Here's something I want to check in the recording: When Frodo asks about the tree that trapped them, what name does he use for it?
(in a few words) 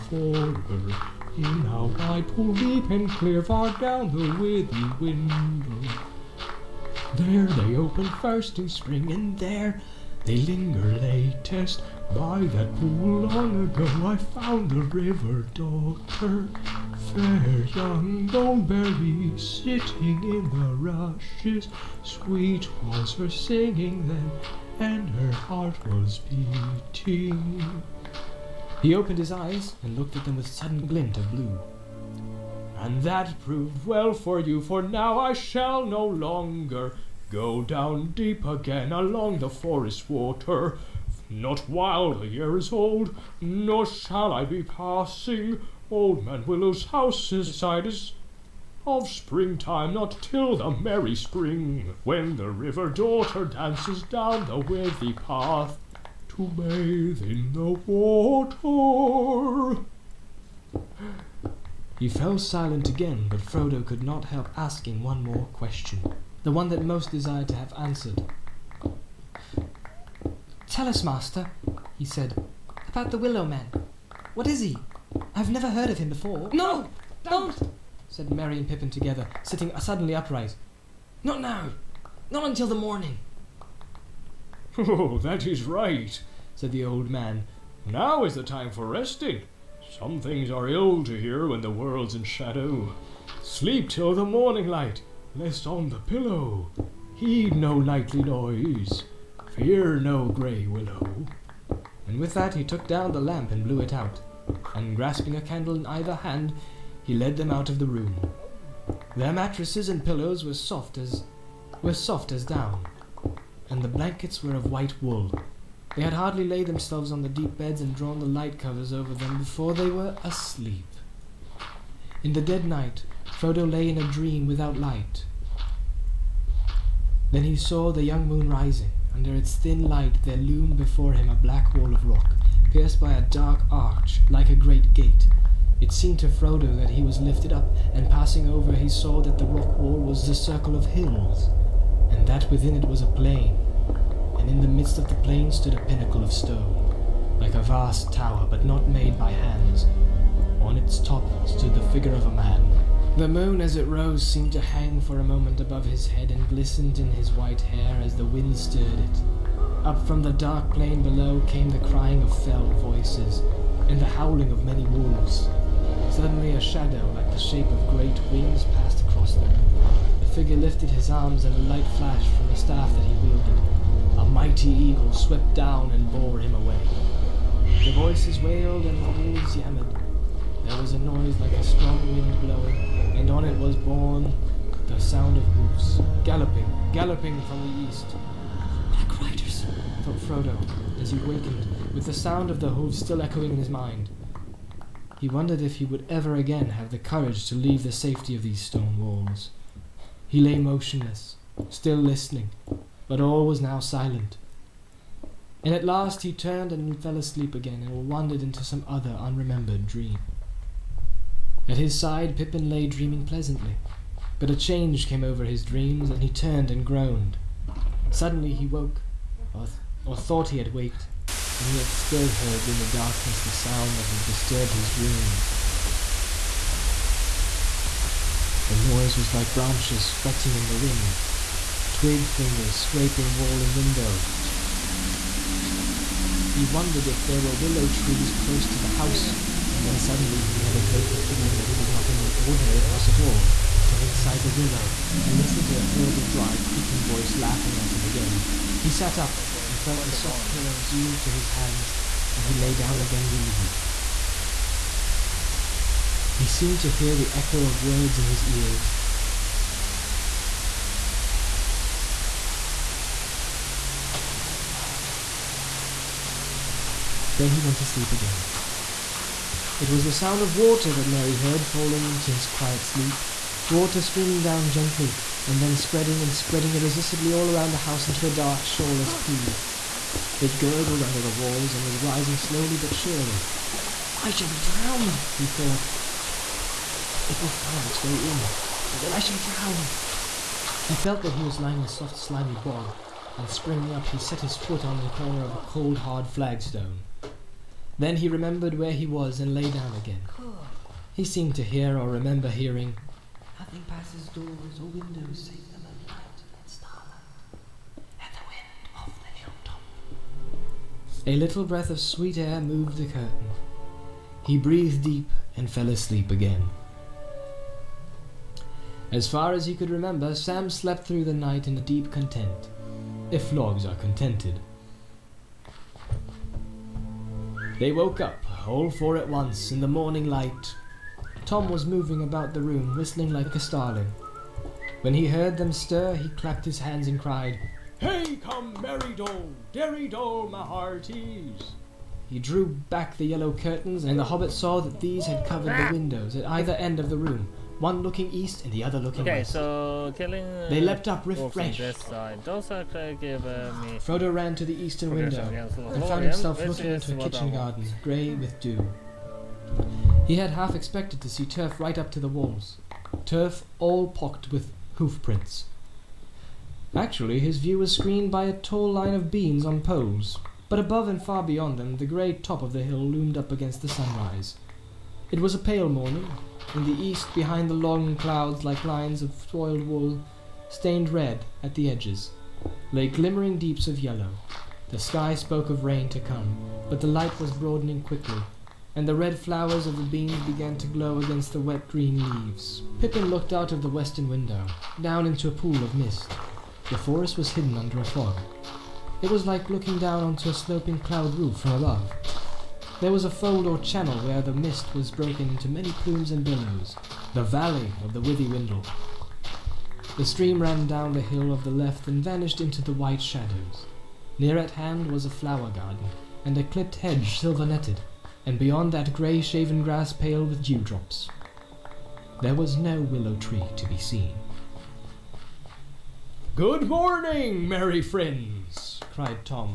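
Willow Man.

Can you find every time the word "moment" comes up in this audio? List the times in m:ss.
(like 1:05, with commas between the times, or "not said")
2:35.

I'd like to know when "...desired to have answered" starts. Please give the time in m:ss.
1:07.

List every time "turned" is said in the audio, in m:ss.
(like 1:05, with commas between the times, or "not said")
3:26, 3:36.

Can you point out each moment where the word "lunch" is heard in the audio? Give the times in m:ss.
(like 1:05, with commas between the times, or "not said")
not said.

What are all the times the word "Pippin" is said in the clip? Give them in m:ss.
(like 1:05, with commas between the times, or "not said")
1:18, 3:32, 6:32.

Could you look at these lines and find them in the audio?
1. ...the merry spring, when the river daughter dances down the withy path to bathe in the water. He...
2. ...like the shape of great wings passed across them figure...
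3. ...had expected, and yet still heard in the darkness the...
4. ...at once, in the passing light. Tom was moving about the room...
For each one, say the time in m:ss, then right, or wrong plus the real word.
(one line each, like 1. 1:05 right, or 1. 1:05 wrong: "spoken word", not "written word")
1. 0:50 right
2. 2:47 right
3. 3:40 wrong: "waked", not "expected"
4. 5:29 wrong: "morning", not "passing".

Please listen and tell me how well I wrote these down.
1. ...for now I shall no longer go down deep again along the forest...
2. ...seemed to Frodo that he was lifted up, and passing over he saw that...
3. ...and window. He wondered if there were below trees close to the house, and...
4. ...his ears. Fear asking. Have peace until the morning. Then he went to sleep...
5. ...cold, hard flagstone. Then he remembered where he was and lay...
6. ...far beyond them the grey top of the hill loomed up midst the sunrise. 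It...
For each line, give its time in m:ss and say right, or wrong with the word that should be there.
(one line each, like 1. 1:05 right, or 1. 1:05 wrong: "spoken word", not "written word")
1. 0:34 right
2. 2:15 right
3. 3:53 wrong: "willow", not "below"
4. 4:18 wrong: "nothing", not "asking"
5. 4:55 right
6. 6:11 wrong: "against", not "midst".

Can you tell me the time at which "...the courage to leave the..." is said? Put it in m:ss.
3:16.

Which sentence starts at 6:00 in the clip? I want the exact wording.
He had half expected to see turf right up to the walls, turf all pocked with hoof prints.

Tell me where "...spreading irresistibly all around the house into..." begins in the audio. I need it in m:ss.
4:36.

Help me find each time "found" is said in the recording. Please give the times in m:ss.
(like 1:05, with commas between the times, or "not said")
0:14, 5:56.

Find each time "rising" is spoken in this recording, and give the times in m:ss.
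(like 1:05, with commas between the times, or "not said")
2:08, 4:41.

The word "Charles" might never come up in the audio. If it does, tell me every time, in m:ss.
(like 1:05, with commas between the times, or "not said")
not said.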